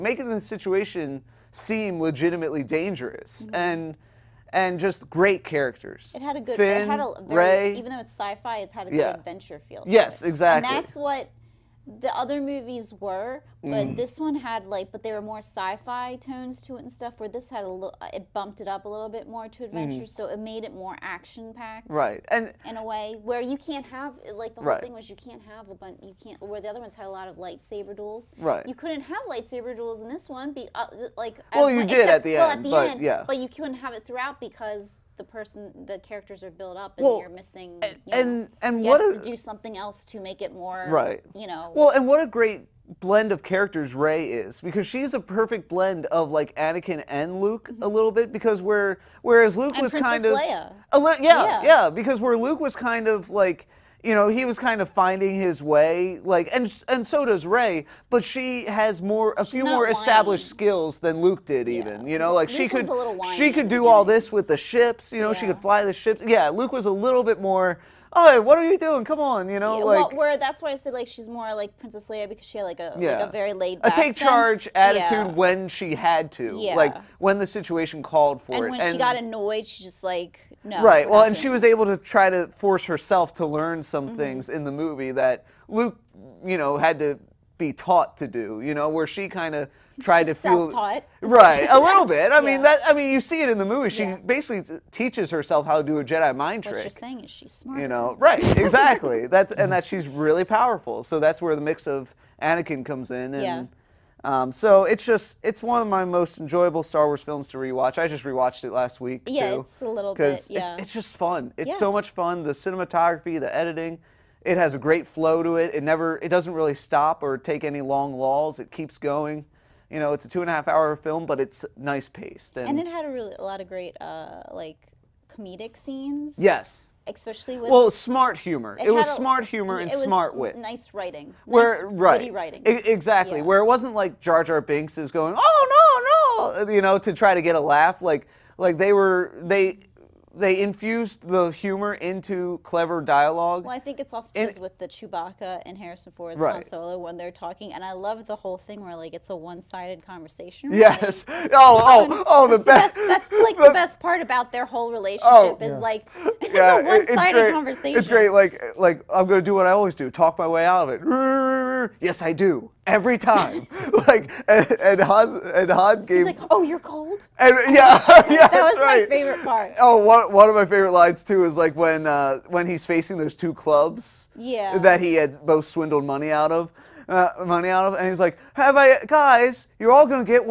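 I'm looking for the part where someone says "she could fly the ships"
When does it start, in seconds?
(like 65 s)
65 s.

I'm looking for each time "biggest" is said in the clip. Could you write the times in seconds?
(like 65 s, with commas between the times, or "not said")
not said.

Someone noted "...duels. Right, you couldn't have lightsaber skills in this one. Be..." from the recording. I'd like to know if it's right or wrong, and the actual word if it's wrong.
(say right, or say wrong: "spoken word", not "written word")
wrong: "duels", not "skills".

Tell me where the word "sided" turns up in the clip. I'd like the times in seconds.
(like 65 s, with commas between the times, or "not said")
149 s, 156 s.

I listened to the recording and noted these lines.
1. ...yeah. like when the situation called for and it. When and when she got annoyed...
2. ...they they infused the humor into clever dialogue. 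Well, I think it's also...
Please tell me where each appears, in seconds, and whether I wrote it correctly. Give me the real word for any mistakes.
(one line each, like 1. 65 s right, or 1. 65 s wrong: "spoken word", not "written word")
1. 76 s right
2. 139 s right.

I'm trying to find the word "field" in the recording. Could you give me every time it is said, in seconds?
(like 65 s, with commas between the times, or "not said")
not said.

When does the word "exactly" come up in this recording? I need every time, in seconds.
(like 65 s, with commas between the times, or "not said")
10 s, 98 s, 132 s.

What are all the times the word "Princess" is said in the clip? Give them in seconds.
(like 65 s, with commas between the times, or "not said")
49 s, 71 s.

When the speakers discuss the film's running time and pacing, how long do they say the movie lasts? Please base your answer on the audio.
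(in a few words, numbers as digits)
2.5 hours.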